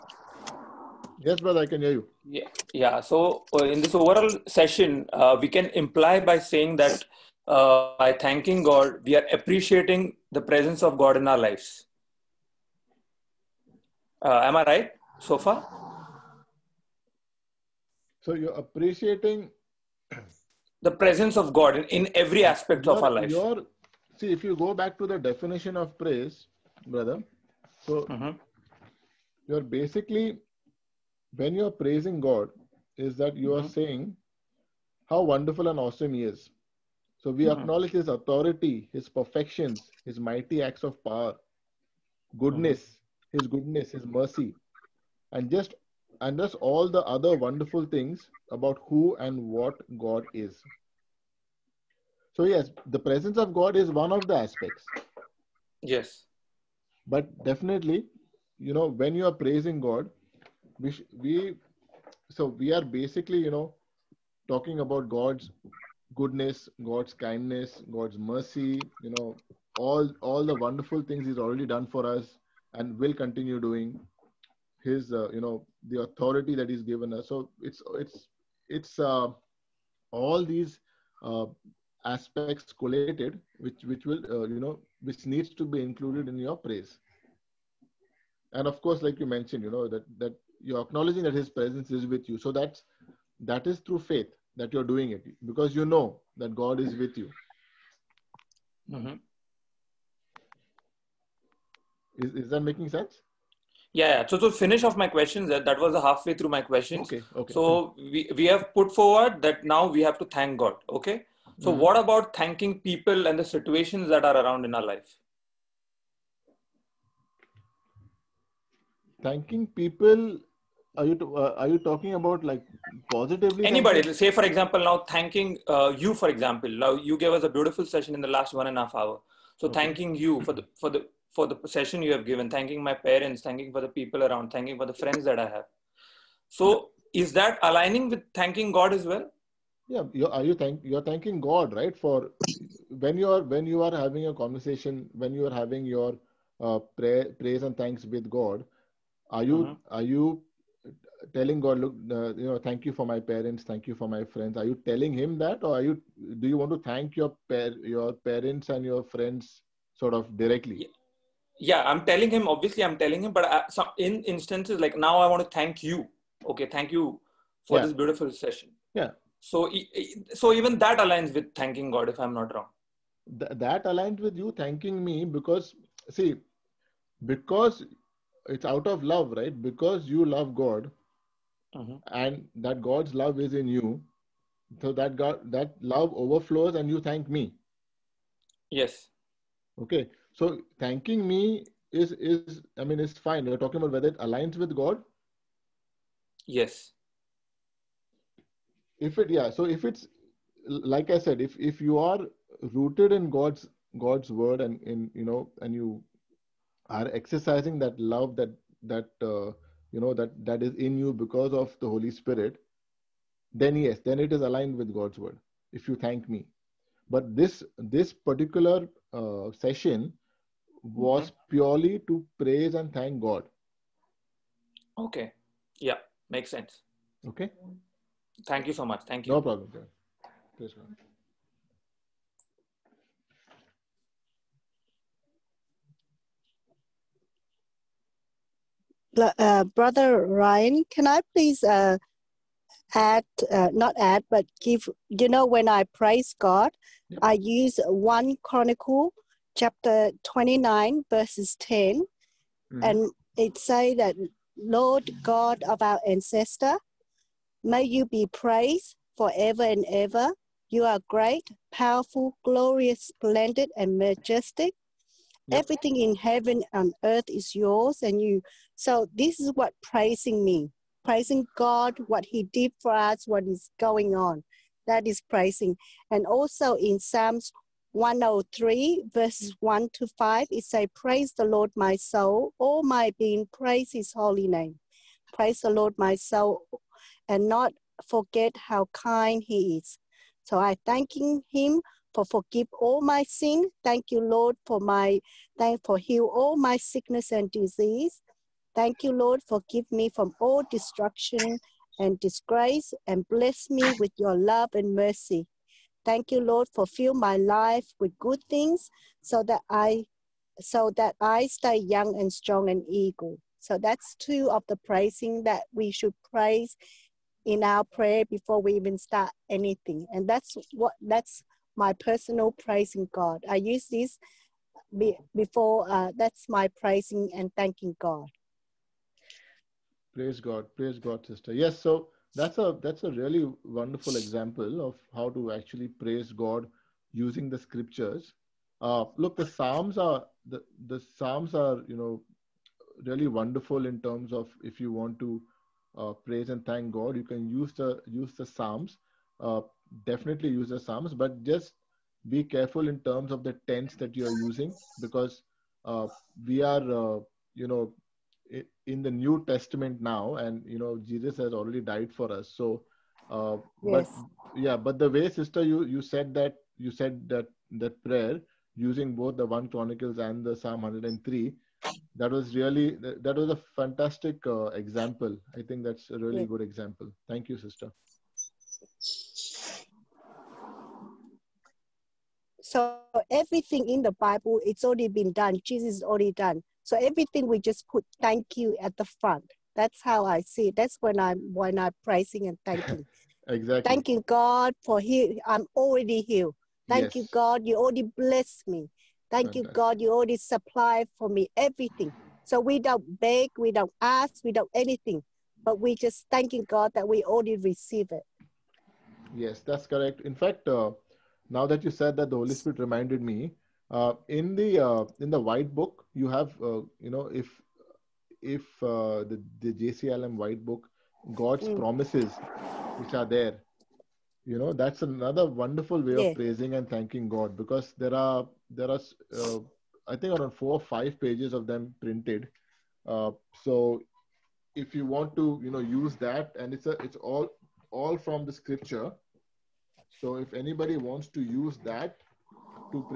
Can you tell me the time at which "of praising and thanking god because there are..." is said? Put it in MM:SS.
07:06.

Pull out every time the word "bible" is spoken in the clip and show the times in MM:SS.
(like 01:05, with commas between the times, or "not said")
06:24.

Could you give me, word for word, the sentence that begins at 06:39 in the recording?
You already supply for me everything.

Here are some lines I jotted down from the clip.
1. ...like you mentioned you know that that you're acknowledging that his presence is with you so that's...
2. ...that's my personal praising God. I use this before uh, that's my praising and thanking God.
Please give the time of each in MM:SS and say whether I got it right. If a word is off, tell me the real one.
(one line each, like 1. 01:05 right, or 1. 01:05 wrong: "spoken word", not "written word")
1. 01:29 right
2. 05:21 right.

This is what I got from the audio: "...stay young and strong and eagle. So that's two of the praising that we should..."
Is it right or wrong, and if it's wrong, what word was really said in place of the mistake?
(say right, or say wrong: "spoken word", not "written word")
right.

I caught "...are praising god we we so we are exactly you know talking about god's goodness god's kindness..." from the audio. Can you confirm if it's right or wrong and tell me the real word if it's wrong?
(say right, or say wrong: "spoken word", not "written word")
wrong: "basically", not "exactly".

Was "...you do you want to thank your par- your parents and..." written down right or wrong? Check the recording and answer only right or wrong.
right.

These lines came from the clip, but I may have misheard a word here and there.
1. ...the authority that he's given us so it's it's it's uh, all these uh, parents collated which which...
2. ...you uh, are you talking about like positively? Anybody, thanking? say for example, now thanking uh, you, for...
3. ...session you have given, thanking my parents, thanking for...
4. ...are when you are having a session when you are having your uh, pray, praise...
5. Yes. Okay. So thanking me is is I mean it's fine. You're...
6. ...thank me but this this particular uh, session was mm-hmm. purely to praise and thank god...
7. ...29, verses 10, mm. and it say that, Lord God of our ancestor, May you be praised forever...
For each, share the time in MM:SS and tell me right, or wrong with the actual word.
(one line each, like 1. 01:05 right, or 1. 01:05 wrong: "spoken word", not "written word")
1. 01:15 wrong: "aspects", not "parents"
2. 02:01 right
3. 02:11 right
4. 02:23 wrong: "conversation", not "session"
5. 03:08 right
6. 03:36 right
7. 04:10 right.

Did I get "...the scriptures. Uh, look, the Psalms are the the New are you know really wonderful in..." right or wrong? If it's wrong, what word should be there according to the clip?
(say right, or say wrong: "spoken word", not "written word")
wrong: "Psalms", not "New".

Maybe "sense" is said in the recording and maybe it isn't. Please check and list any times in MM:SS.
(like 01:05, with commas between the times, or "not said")
01:42, 03:46.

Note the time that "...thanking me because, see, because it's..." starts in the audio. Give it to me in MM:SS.
02:54.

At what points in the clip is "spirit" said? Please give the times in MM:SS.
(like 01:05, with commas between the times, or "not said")
03:32, 06:52.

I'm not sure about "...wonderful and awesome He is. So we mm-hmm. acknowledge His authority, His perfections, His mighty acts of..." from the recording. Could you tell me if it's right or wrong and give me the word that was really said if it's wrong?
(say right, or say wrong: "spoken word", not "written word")
right.